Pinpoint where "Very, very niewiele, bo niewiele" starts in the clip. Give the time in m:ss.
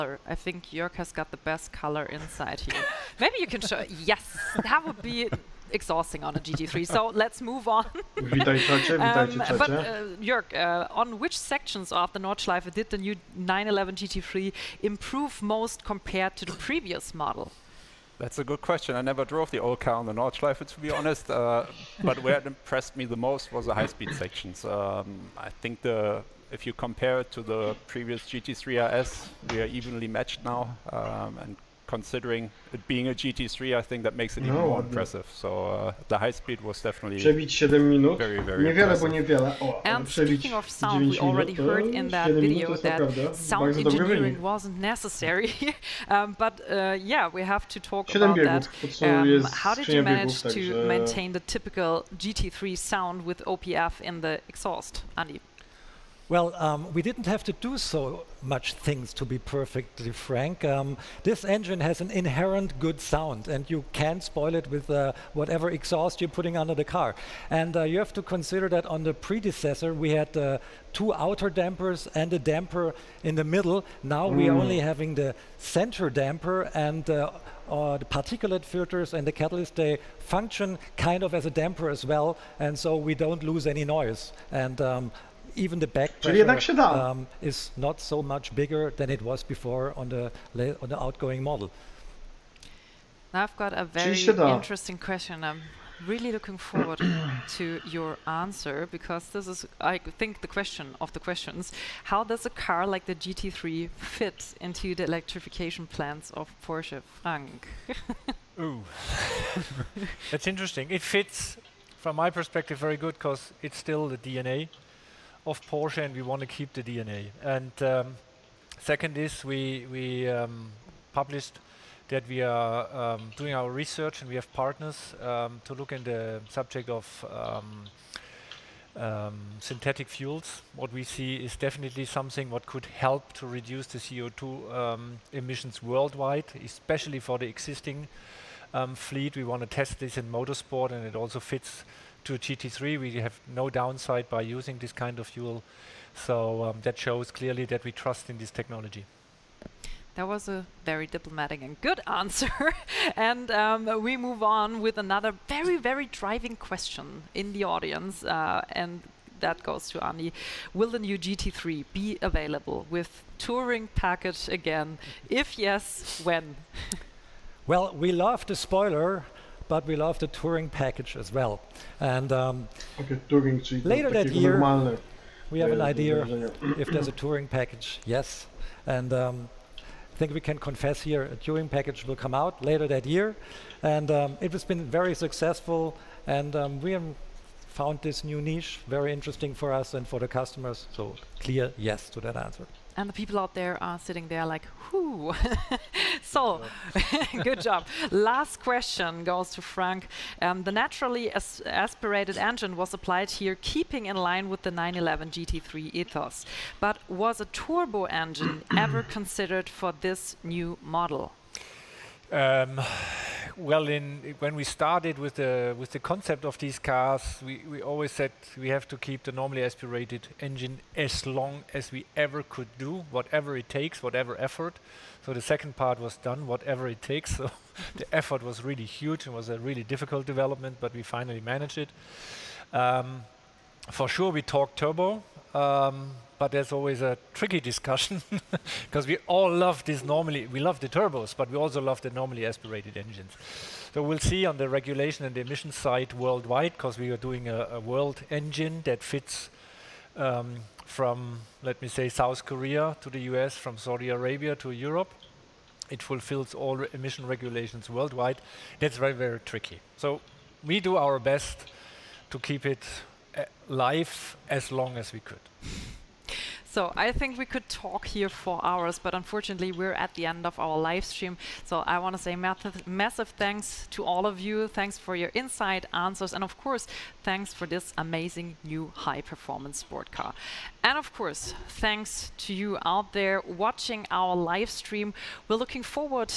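0:38.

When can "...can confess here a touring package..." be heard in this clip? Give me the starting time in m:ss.
3:00.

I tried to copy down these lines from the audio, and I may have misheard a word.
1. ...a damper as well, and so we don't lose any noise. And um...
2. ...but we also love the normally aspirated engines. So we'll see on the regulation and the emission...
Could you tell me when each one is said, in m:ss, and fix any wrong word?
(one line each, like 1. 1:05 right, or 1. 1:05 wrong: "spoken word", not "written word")
1. 1:21 right
2. 4:01 right.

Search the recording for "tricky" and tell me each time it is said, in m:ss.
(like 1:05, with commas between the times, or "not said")
3:57, 4:19.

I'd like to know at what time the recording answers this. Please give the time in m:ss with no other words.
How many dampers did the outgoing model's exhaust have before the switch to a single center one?
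1:10.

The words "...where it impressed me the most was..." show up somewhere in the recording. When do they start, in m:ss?
0:22.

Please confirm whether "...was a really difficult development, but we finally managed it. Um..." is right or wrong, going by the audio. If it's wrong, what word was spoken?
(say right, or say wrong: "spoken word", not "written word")
right.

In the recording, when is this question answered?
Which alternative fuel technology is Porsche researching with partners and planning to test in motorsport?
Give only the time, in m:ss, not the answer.
2:09.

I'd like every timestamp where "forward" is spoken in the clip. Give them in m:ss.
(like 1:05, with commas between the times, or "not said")
1:36, 4:45.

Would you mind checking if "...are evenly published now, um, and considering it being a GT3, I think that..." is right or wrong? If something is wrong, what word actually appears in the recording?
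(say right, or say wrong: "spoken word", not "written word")
wrong: "matched", not "published".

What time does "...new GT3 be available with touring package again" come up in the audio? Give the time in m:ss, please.
2:40.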